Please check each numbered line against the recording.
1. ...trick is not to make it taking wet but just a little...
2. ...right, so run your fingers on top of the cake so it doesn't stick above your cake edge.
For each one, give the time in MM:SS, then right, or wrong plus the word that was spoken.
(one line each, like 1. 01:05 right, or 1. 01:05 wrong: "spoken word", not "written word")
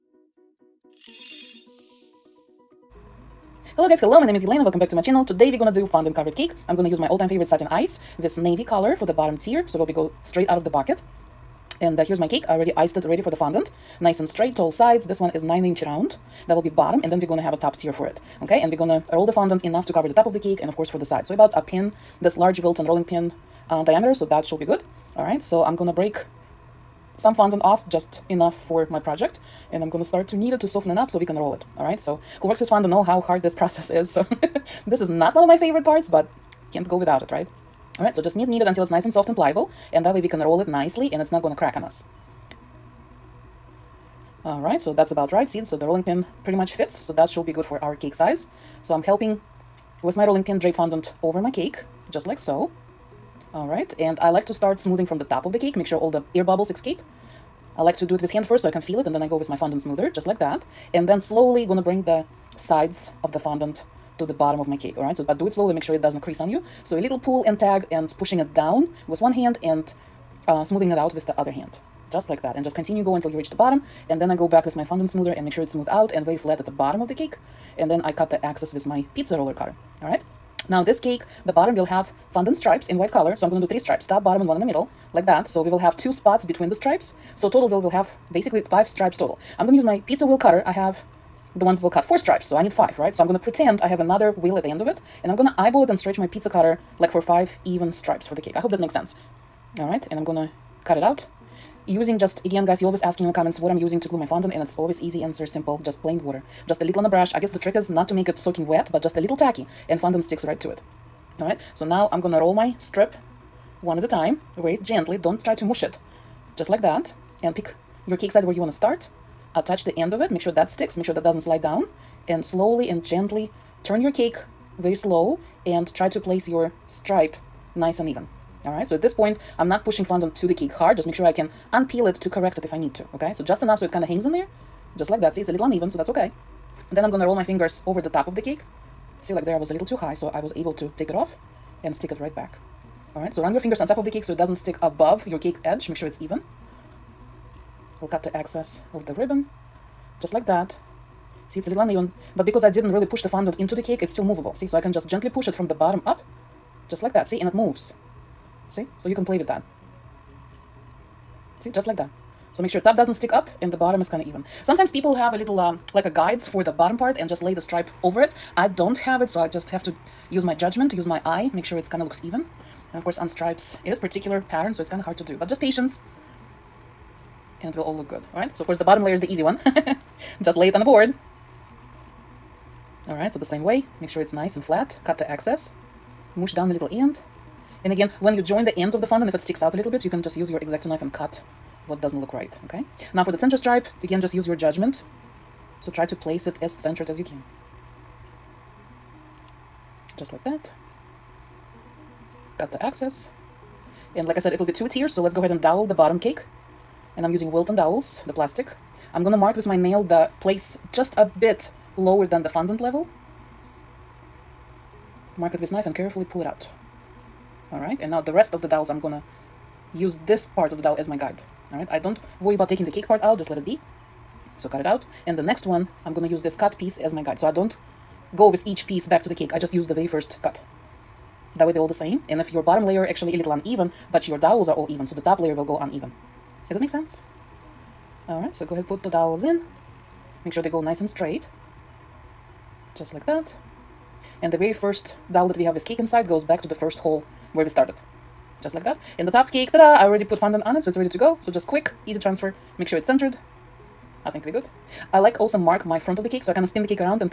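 1. 01:47 wrong: "soaking", not "taking"
2. 02:23 right.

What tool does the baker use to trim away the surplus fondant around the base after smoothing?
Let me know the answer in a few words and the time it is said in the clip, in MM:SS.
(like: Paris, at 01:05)
pizza roller cutter, at 01:19.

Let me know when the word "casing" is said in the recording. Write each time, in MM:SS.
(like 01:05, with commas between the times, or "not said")
not said.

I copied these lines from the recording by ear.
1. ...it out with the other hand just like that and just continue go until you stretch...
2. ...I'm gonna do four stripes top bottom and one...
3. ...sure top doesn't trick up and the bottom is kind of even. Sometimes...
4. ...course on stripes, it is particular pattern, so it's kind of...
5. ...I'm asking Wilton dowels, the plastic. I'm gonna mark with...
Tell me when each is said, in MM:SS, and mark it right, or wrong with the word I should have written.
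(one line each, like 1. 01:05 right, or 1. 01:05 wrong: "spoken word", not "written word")
1. 01:10 wrong: "reach", not "stretch"
2. 01:23 wrong: "three", not "four"
3. 02:42 wrong: "stick", not "trick"
4. 02:53 right
5. 03:27 wrong: "using", not "asking".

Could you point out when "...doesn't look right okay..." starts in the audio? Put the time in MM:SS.
03:12.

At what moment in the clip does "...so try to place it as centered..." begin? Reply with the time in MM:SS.
03:15.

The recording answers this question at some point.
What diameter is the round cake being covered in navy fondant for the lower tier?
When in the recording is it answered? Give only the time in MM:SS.
00:15.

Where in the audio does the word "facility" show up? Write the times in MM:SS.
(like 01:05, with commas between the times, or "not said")
not said.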